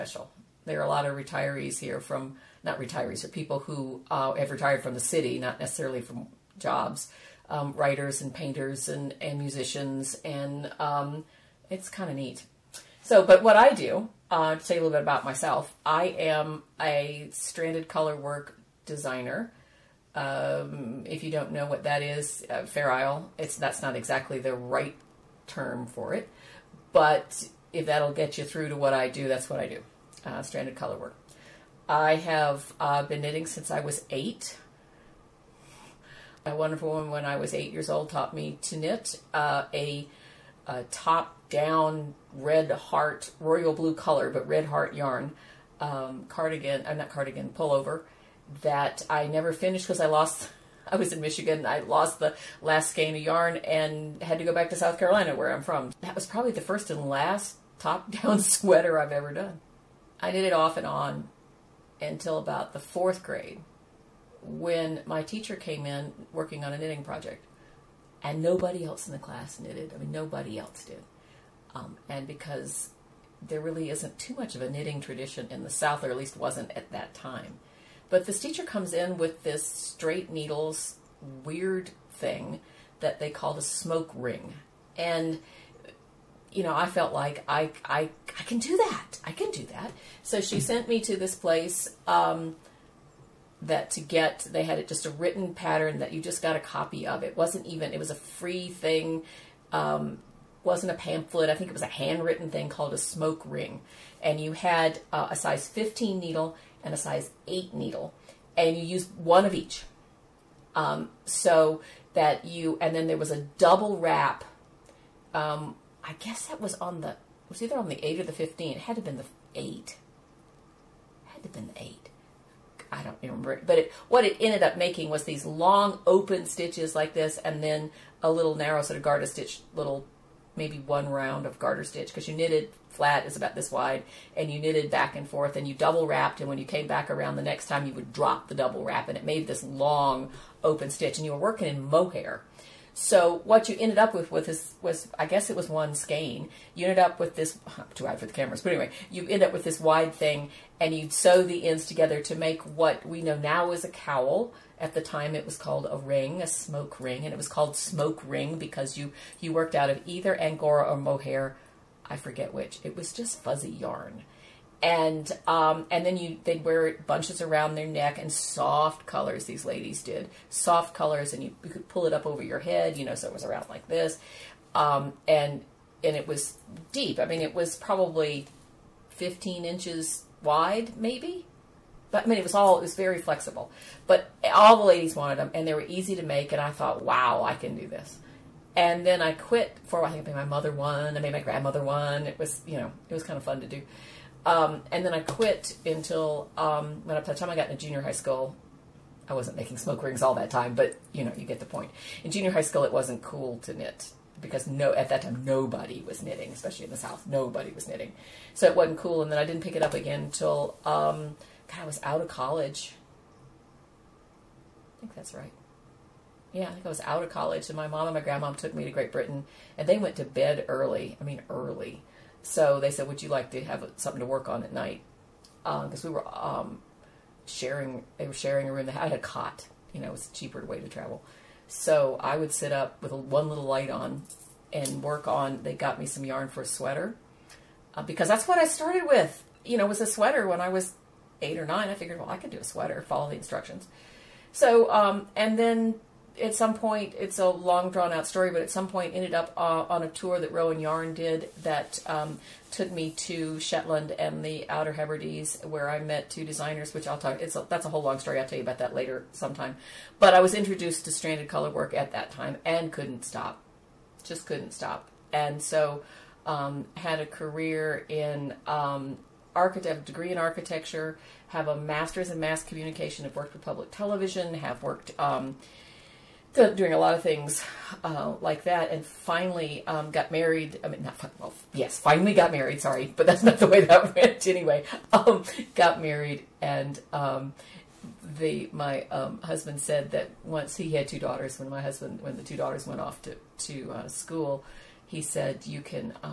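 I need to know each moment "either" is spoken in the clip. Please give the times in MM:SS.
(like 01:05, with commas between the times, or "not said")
01:57, 02:40.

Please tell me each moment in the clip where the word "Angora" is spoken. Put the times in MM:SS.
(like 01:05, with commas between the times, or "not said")
02:40.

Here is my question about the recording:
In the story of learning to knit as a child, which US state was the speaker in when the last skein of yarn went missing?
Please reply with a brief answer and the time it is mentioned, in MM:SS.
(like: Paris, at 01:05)
Michigan, at 00:51.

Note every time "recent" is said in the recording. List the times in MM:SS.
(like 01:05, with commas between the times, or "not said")
not said.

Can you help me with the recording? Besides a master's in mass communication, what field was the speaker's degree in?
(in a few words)
architecture.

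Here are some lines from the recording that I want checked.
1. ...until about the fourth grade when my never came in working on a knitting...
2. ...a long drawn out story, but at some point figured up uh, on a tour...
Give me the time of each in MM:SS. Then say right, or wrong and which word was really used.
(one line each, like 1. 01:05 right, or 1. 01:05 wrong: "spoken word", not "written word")
1. 01:01 wrong: "teacher", not "never"
2. 04:07 wrong: "ended", not "figured".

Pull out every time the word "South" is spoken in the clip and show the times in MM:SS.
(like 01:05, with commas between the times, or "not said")
00:54, 01:15, 03:26.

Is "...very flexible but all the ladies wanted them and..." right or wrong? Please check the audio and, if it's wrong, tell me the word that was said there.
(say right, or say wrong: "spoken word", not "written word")
right.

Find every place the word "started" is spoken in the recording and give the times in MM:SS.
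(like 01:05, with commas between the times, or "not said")
03:58.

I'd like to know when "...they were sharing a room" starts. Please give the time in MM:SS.
03:48.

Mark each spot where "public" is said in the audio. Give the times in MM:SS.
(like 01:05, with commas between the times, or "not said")
04:33.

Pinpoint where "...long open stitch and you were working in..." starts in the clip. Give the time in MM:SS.
02:19.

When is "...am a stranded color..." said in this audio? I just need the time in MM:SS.
00:16.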